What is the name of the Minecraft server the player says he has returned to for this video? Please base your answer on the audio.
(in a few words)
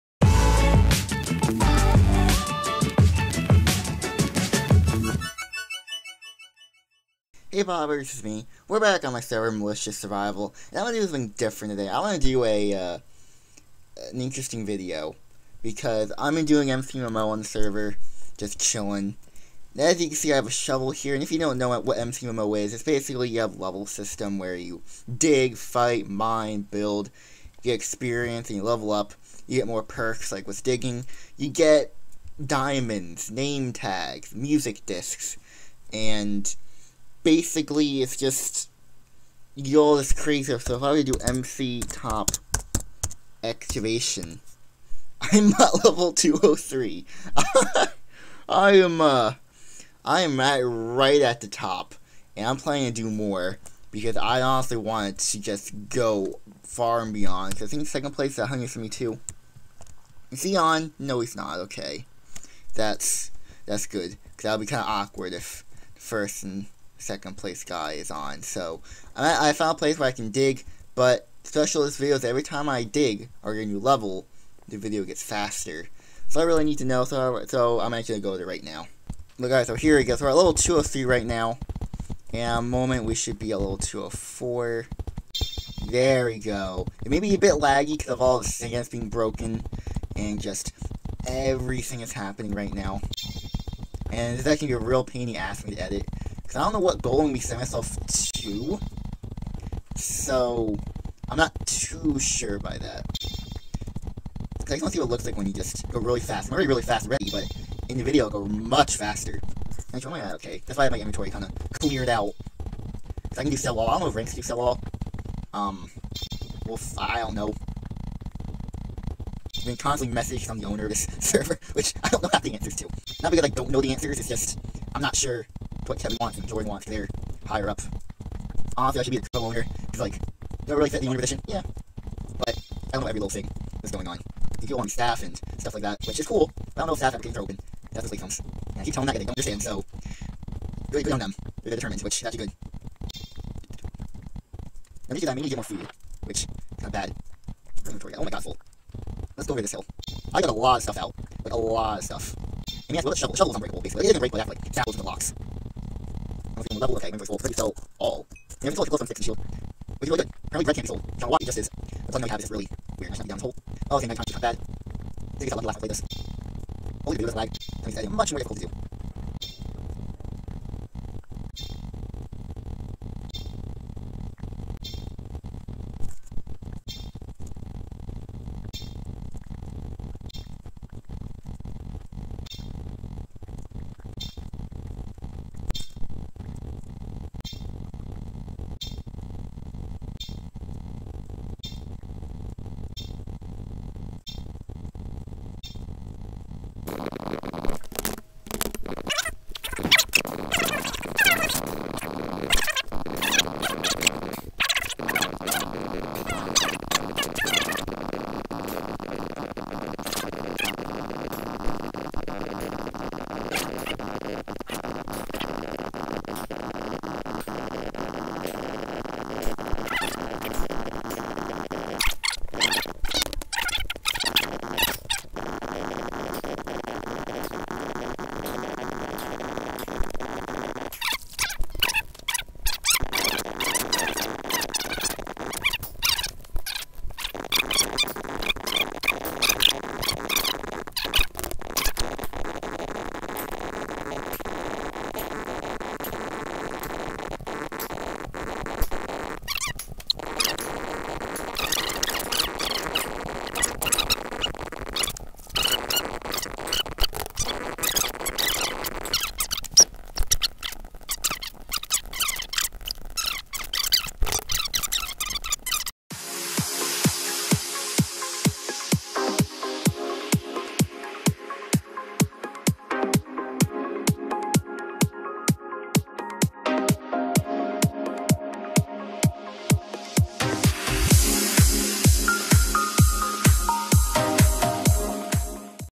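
Malicious Survival.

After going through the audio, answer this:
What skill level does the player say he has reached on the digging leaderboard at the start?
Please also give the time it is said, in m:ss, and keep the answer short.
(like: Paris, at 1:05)
203, at 0:45.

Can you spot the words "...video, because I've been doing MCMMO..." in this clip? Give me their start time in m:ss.
0:14.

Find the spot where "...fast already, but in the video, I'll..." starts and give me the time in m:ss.
1:46.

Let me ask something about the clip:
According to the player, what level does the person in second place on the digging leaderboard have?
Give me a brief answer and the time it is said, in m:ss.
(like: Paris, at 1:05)
172, at 0:57.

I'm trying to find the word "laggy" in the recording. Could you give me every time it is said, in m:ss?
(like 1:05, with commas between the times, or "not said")
1:27.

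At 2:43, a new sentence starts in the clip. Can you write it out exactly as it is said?
Oh, okay, my conscience is not bad.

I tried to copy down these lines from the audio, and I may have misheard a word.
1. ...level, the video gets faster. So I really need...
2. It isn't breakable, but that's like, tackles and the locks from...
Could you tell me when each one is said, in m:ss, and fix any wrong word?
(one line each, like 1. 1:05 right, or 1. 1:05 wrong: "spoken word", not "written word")
1. 1:13 right
2. 2:34 right.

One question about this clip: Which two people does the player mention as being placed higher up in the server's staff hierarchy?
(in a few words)
Kevin Watts and Jordan Watts.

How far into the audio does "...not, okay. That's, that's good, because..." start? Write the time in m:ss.
1:01.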